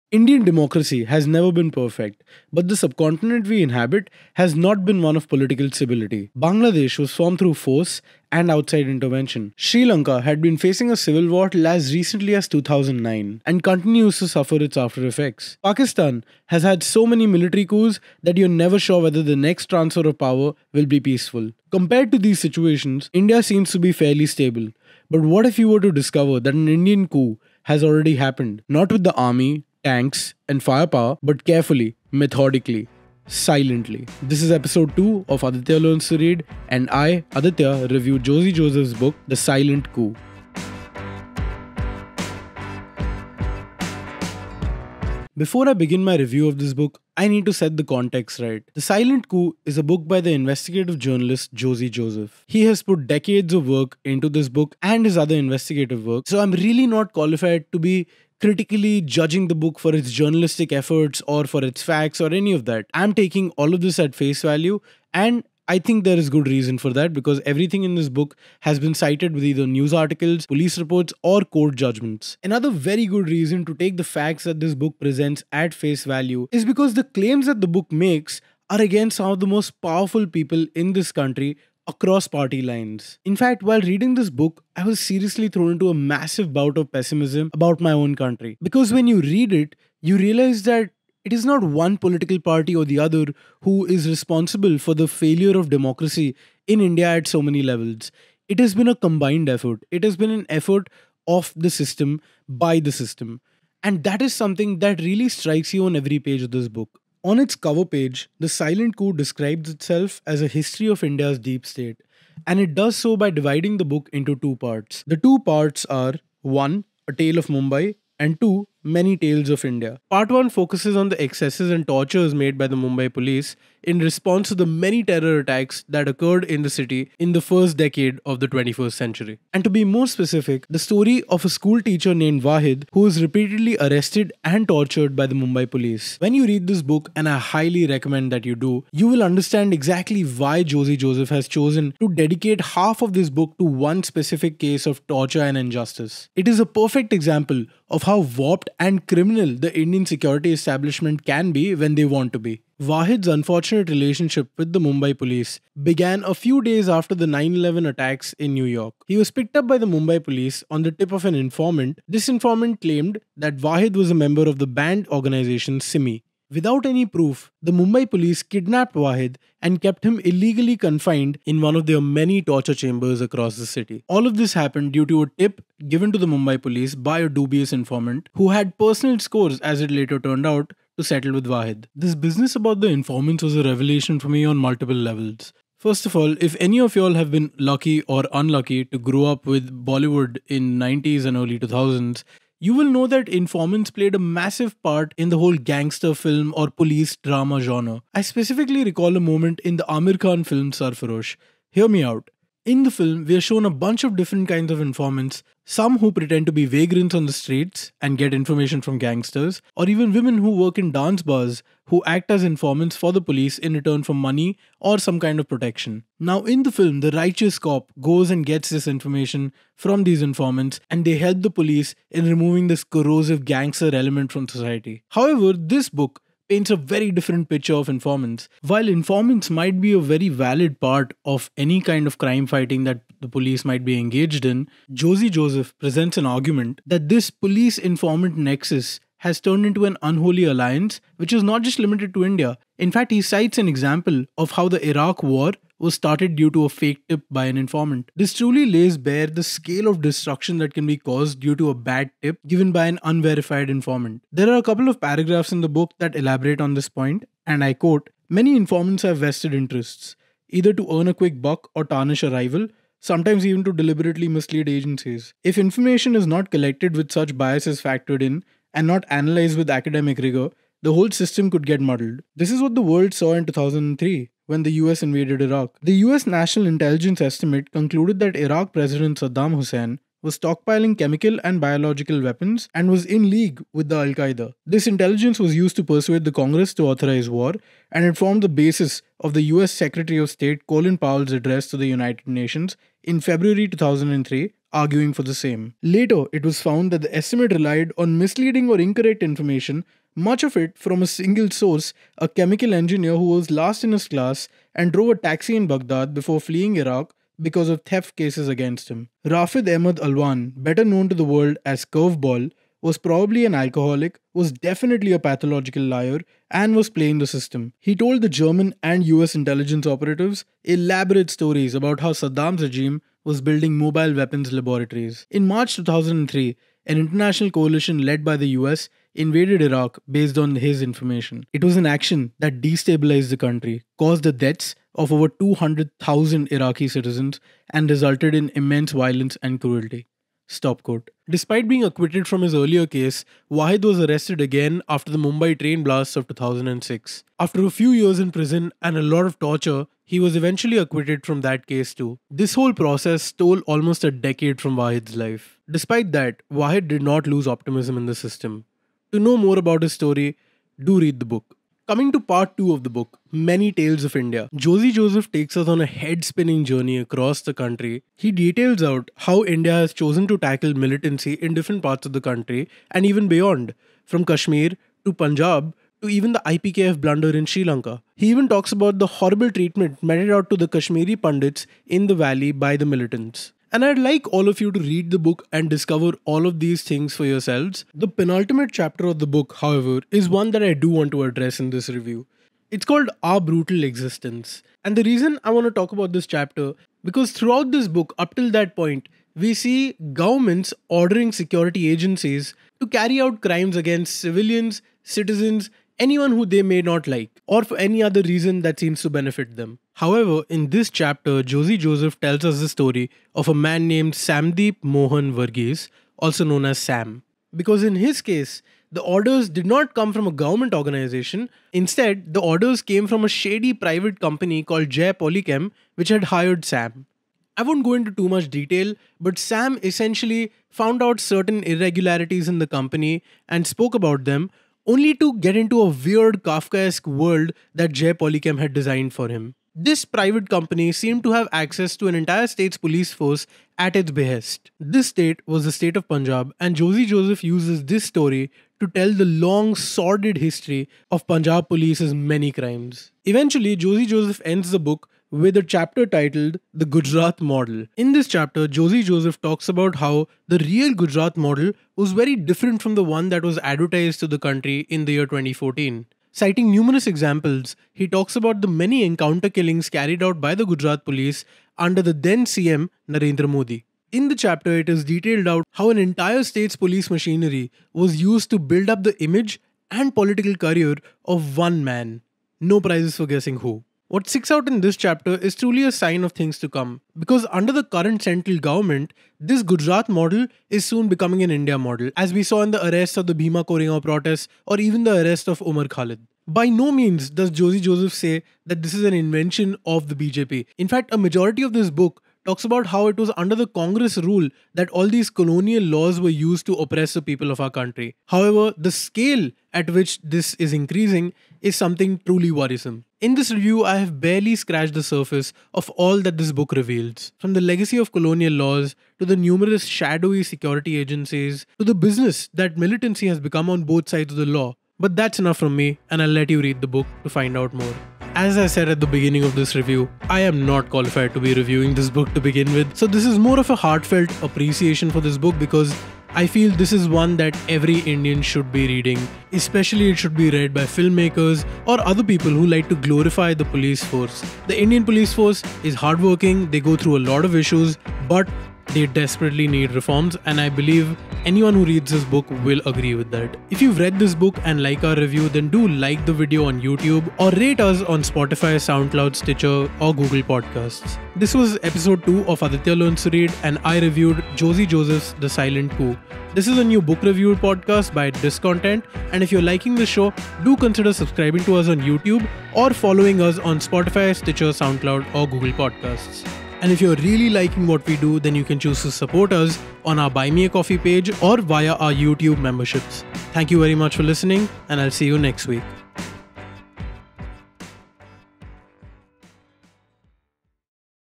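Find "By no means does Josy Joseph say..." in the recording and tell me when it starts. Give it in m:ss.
8:16.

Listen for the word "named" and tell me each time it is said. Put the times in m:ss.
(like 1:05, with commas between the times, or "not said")
2:12, 6:53.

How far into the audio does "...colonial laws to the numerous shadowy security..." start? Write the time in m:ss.
8:38.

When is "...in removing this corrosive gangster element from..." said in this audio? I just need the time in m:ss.
3:42.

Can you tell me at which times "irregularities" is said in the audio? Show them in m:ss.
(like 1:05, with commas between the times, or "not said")
7:11.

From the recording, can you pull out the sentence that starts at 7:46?
Citing numerous examples, he talks about the many encounter killings carried out by the Gujarat police under the then CM Narendra Modi.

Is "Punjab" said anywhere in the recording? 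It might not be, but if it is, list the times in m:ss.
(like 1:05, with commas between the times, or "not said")
6:15, 7:26, 7:31.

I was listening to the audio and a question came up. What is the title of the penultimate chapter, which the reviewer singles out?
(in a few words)
Our Brutal Existence.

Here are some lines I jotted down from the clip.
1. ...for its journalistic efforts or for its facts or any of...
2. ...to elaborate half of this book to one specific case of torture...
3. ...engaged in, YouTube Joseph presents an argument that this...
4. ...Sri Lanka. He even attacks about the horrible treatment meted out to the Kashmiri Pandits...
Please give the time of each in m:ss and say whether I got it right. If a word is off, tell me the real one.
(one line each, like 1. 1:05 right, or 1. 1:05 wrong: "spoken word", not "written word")
1. 0:59 right
2. 2:21 wrong: "dedicate", not "elaborate"
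3. 3:53 wrong: "Josy", not "YouTube"
4. 6:17 wrong: "talks", not "attacks".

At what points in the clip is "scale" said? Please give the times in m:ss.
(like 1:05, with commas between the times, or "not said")
4:09, 8:28.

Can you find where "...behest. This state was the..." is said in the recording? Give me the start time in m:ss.
7:24.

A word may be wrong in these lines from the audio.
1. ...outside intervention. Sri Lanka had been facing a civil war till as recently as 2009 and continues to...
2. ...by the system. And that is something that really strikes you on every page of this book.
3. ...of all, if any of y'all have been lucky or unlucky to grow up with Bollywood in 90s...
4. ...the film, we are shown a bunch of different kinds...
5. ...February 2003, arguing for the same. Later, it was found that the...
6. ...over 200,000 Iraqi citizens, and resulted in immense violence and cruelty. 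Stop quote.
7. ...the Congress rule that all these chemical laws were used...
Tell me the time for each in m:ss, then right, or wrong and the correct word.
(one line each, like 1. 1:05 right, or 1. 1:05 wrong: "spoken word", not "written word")
1. 0:08 right
2. 1:42 right
3. 3:06 right
4. 3:22 right
5. 4:53 right
6. 5:35 right
7. 8:23 wrong: "colonial", not "chemical".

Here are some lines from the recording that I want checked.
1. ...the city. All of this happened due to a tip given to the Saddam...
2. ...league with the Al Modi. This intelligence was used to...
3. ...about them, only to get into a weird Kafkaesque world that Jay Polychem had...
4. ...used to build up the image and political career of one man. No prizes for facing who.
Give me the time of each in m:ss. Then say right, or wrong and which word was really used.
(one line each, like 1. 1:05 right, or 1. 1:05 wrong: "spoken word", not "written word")
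1. 2:53 wrong: "Mumbai", not "Saddam"
2. 4:43 wrong: "Qaeda", not "Modi"
3. 7:13 right
4. 7:58 wrong: "guessing", not "facing".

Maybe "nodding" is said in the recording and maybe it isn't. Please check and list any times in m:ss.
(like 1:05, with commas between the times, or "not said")
not said.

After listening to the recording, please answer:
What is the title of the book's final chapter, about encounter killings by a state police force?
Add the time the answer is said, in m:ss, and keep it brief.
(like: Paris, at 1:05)
The Gujarat Model, at 7:36.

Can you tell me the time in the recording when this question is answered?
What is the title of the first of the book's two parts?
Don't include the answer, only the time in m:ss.
1:57.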